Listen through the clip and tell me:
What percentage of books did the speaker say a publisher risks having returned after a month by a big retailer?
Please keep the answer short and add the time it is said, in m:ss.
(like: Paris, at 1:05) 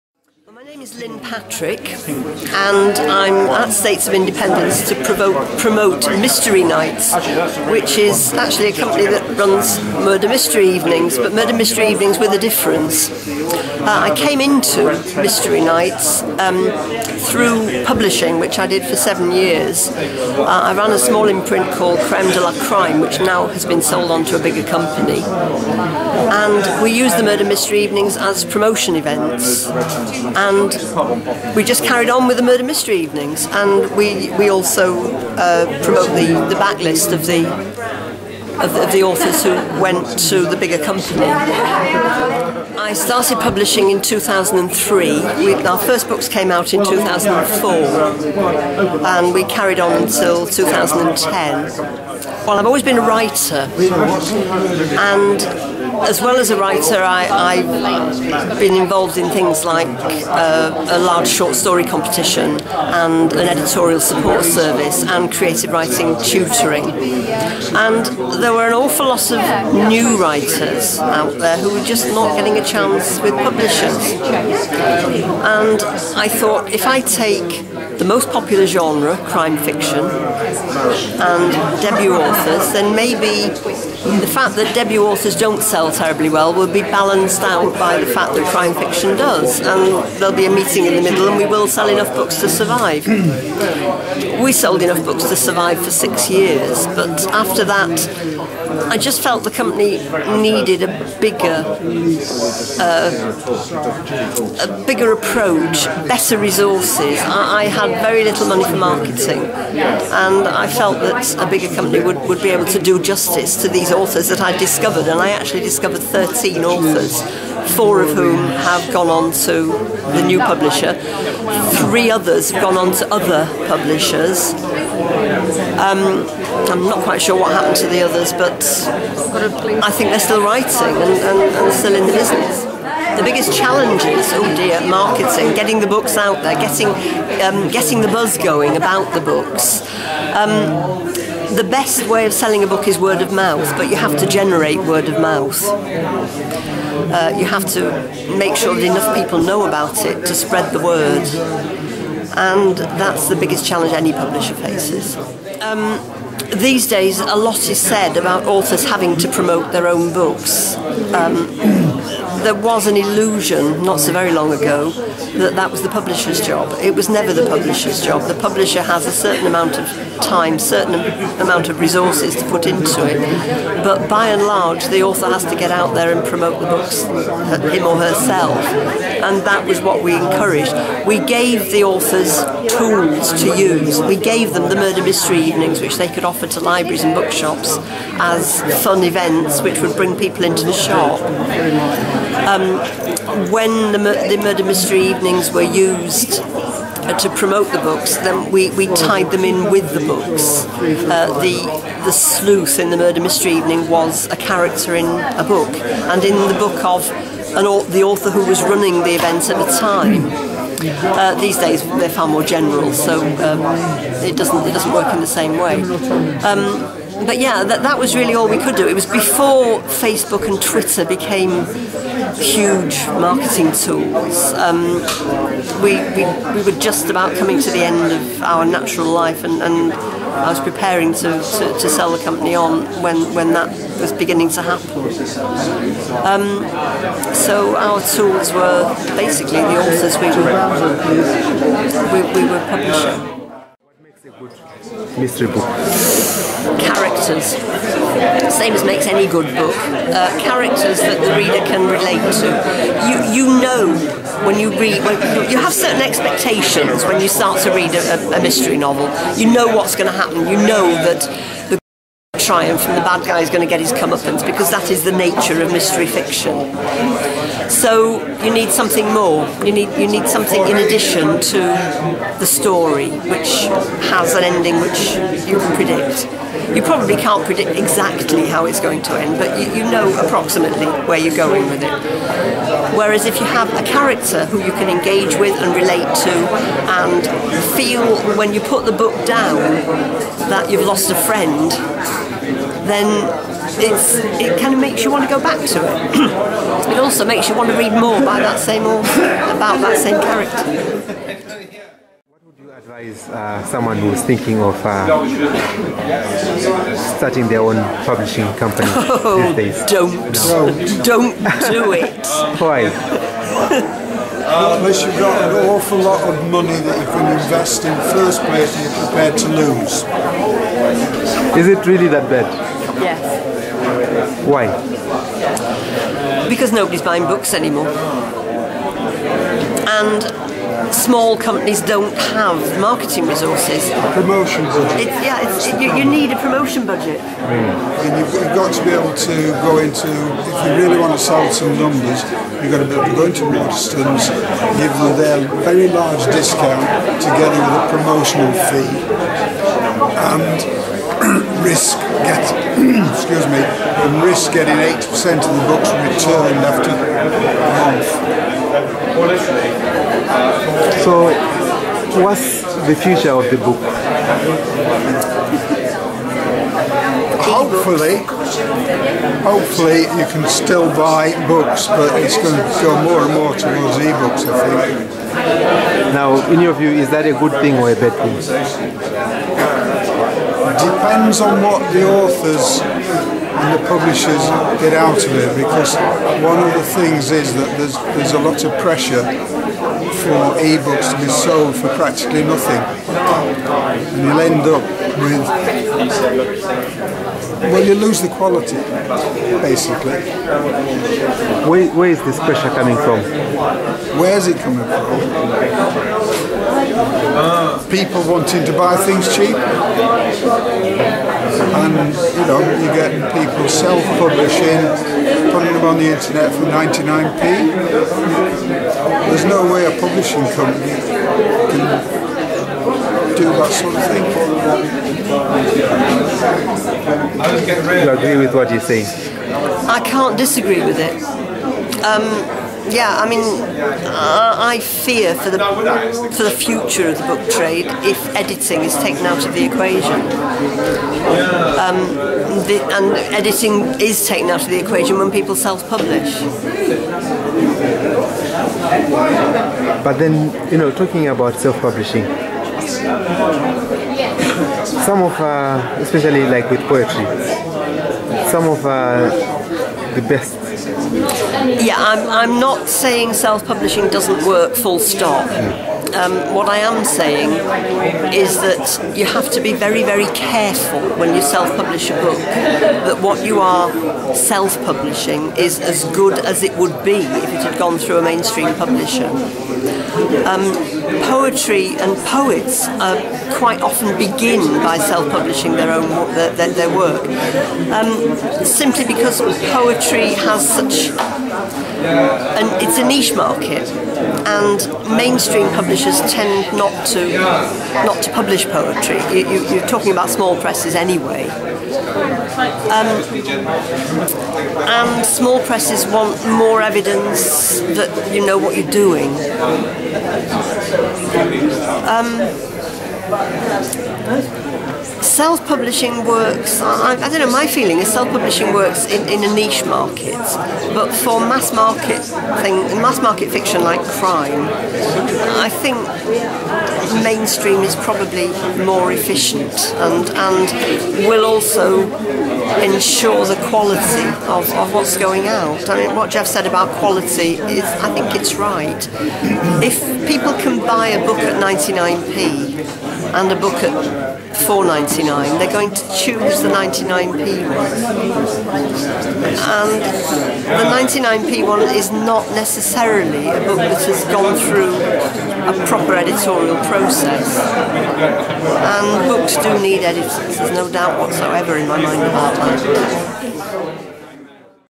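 8%, at 5:54.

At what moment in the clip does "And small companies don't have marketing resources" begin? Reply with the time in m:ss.
5:29.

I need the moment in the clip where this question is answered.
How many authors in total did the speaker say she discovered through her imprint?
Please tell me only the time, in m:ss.
1:56.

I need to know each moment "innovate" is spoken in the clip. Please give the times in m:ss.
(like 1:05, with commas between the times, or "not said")
not said.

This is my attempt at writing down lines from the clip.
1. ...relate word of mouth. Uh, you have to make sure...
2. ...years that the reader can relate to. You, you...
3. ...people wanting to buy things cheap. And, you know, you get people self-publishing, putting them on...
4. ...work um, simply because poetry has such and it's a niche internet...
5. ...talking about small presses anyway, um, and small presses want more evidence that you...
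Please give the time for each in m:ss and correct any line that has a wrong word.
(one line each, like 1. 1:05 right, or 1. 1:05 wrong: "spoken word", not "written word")
1. 2:24 wrong: "generate", not "relate"
2. 4:10 wrong: "characters", not "years"
3. 6:47 right
4. 8:06 wrong: "market", not "internet"
5. 8:19 right.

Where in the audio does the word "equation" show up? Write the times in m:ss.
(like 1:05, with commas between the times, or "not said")
7:19, 7:24.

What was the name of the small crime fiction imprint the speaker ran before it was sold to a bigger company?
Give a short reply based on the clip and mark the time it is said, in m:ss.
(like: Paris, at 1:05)
Creme de la Crime, at 0:22.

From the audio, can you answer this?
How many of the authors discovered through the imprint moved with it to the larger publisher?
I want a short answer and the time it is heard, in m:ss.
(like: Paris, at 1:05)
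4, at 1:57.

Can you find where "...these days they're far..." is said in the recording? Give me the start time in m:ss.
3:31.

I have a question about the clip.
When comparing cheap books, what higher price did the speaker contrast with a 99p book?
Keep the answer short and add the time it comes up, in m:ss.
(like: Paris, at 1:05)
£4.99, at 9:04.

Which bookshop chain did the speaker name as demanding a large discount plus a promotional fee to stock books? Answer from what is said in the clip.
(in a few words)
Waterstones.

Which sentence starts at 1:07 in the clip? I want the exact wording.
And there were an awful lot of new writers out there who were just not getting a chance with publishers.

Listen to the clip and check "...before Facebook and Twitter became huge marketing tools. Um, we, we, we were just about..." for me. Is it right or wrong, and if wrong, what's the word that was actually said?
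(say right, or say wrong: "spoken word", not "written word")
right.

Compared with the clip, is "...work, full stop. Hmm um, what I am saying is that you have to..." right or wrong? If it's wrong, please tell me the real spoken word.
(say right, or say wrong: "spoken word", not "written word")
right.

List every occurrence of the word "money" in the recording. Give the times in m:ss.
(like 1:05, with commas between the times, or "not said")
1:48, 5:16.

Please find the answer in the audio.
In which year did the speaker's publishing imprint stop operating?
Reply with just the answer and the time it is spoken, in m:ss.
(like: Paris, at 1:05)
2010, at 0:50.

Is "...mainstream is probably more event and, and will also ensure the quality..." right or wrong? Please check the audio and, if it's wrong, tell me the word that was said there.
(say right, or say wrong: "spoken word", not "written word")
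wrong: "efficient", not "event".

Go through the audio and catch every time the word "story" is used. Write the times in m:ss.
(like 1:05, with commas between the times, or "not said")
1:01, 4:32.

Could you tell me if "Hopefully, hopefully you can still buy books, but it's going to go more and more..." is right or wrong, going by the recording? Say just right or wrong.
right.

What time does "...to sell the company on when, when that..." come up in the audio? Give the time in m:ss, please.
3:51.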